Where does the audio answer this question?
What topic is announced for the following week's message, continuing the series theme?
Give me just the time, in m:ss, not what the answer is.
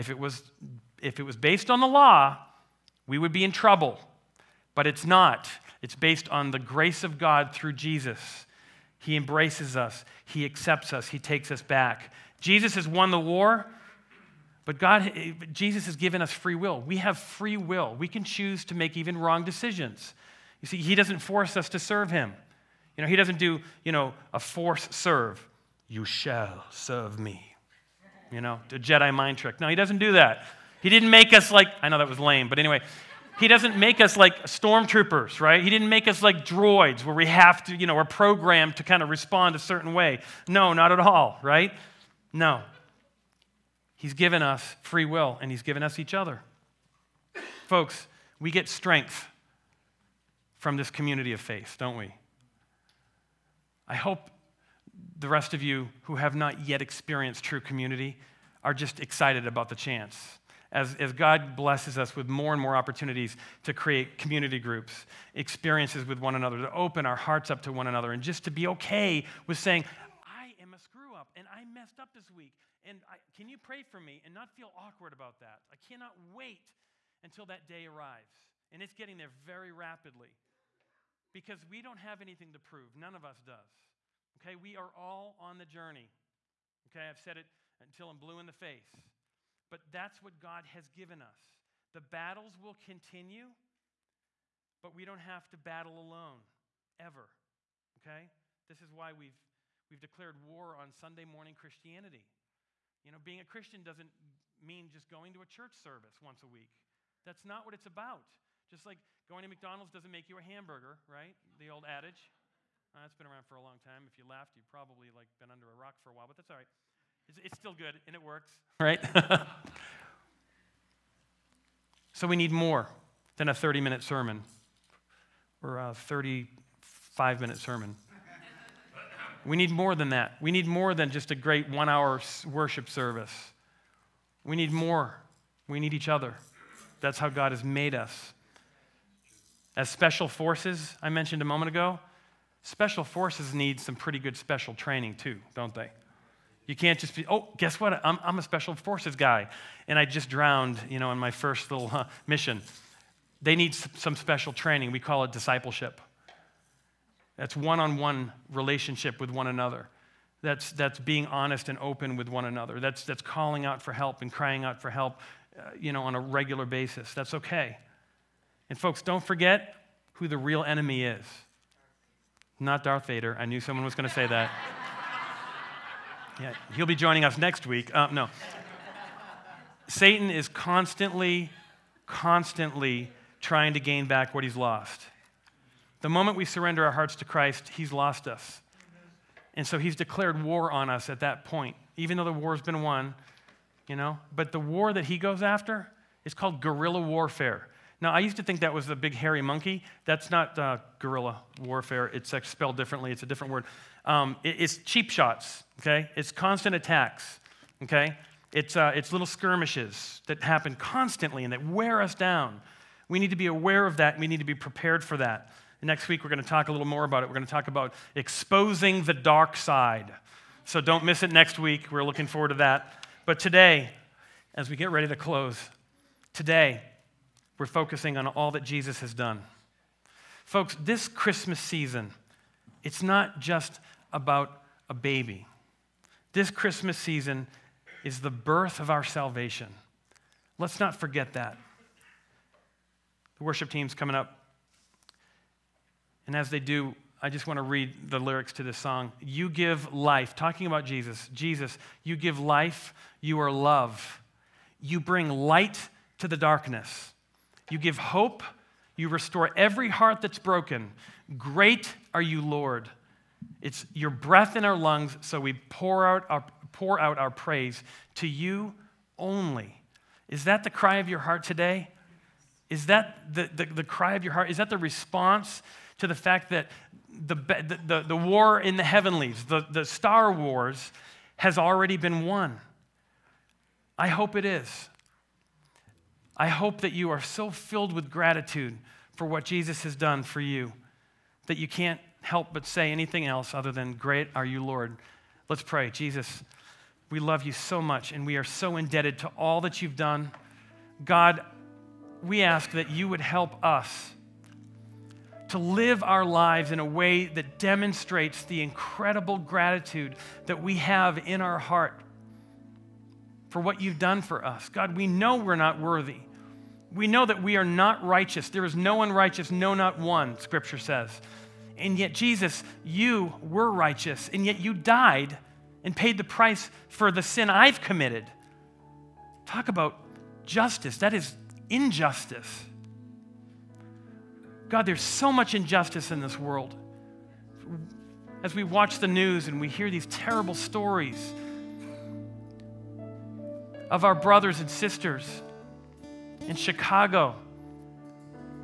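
3:38.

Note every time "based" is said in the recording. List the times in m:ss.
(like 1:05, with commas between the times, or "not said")
0:01, 0:05.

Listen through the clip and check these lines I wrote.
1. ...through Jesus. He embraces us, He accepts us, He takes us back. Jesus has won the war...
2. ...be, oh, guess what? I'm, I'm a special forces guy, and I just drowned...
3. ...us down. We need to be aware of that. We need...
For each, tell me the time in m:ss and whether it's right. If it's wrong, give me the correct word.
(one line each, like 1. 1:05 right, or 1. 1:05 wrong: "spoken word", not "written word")
1. 0:07 right
2. 2:27 right
3. 3:31 right.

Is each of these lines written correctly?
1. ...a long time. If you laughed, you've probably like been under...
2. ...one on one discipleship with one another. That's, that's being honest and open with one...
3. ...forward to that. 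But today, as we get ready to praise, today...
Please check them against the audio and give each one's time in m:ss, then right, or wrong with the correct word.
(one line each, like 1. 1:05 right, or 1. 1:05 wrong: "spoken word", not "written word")
1. 1:53 right
2. 2:37 wrong: "relationship", not "discipleship"
3. 3:42 wrong: "close", not "praise".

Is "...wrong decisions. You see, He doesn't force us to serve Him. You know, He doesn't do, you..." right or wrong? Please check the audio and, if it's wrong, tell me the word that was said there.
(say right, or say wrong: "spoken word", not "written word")
right.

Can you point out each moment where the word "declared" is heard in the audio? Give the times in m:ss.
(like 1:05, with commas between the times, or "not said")
1:39, 3:09.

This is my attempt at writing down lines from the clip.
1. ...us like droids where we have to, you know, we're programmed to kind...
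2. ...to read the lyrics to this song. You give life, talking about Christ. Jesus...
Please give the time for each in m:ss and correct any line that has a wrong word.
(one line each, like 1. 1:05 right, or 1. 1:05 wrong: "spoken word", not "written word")
1. 0:36 right
2. 4:07 wrong: "Jesus", not "Christ".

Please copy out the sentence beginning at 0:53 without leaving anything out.
I hope the rest of you who have not yet experienced true community are just excited about the chance.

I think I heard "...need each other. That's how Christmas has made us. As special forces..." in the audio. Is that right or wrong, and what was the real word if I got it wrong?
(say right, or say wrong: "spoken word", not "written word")
wrong: "God", not "Christmas".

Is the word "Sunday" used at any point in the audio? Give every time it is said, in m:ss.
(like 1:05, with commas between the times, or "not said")
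1:40.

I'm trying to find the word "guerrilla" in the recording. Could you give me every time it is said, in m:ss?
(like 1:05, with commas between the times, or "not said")
3:16, 3:20.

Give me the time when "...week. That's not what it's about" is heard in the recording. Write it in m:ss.
1:46.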